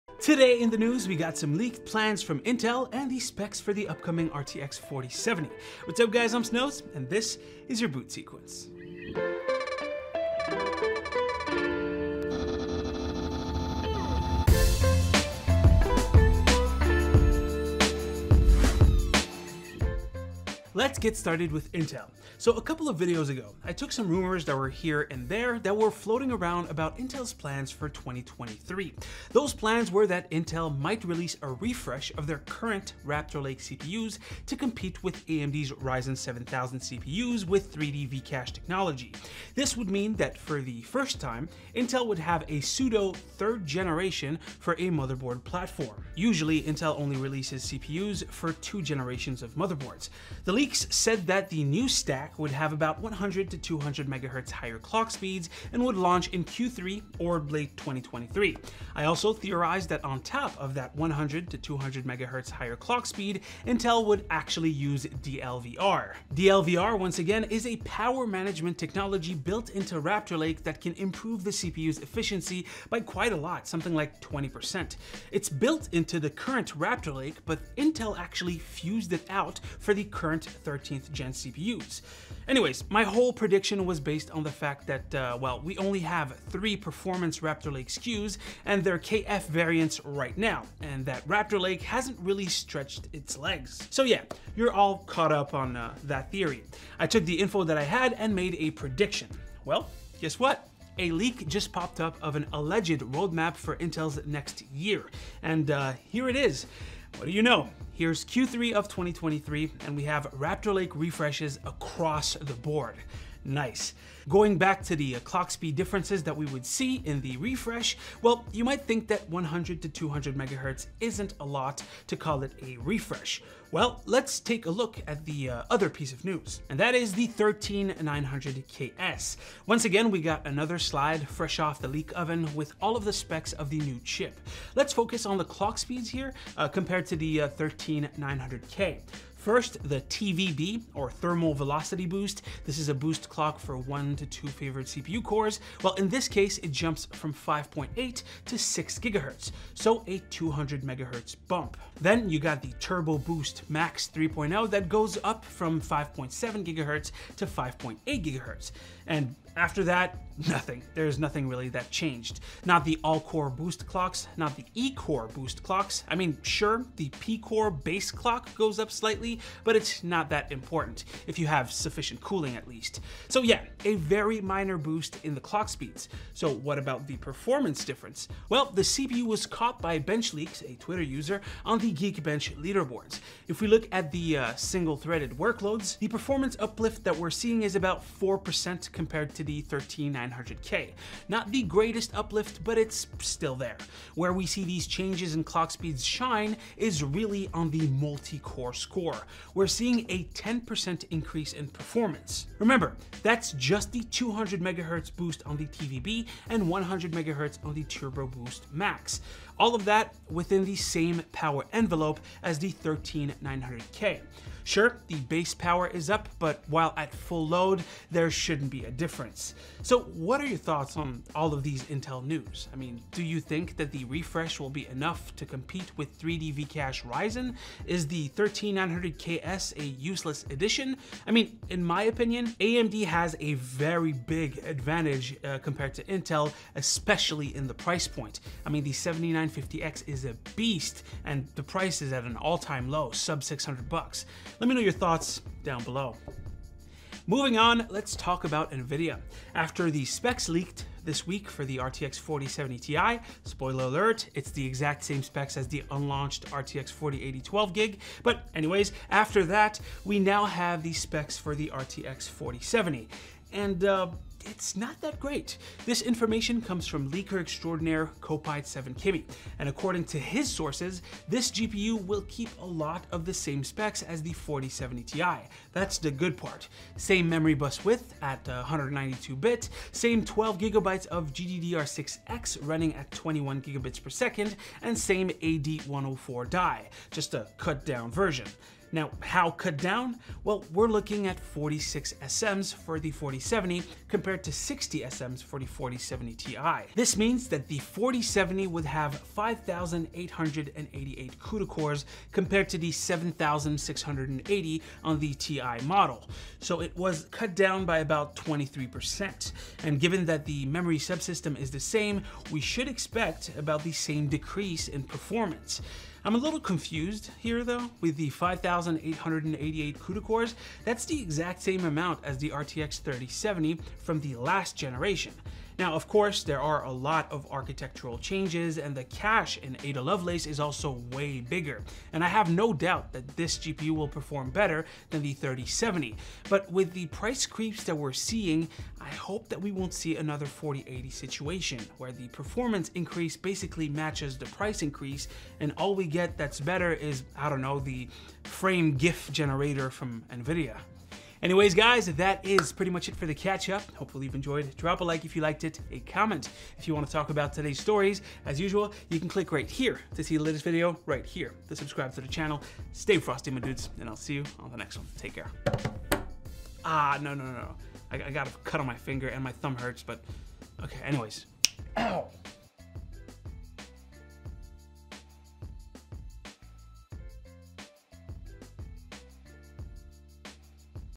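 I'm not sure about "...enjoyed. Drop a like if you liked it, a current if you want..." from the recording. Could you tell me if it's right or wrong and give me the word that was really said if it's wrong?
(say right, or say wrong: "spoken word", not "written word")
wrong: "comment", not "current".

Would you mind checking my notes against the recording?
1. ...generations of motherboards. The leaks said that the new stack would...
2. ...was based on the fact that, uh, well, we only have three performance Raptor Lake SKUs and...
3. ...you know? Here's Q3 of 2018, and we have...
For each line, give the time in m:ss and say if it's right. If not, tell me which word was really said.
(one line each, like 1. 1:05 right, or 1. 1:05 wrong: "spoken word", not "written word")
1. 0:48 right
2. 1:23 right
3. 1:47 wrong: "2023", not "2018".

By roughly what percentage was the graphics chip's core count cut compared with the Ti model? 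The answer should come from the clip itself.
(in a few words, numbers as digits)
23%.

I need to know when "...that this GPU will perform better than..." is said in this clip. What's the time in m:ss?
5:33.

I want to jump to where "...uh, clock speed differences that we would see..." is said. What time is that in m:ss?
1:55.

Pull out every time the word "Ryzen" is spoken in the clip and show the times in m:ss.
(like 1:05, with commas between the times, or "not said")
0:35, 3:47.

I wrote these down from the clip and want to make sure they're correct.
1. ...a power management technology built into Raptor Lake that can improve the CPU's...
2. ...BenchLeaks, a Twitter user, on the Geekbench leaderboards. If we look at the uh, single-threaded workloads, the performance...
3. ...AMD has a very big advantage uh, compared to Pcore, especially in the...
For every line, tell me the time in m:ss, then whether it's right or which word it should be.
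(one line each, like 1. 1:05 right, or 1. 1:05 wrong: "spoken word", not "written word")
1. 1:07 right
2. 2:59 right
3. 3:52 wrong: "Intel", not "Pcore".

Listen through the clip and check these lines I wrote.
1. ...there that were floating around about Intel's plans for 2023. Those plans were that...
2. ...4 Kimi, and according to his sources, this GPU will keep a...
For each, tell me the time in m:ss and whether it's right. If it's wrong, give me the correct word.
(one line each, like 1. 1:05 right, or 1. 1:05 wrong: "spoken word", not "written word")
1. 0:25 right
2. 4:28 wrong: "7", not "4".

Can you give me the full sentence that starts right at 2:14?
Let's focus on the clock speeds here uh, compared to the 13900K.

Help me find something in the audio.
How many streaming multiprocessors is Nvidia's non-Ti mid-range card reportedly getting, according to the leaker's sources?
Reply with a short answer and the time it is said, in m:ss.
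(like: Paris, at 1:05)
46, at 4:51.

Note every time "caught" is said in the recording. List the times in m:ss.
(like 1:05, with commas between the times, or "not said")
1:34, 2:59.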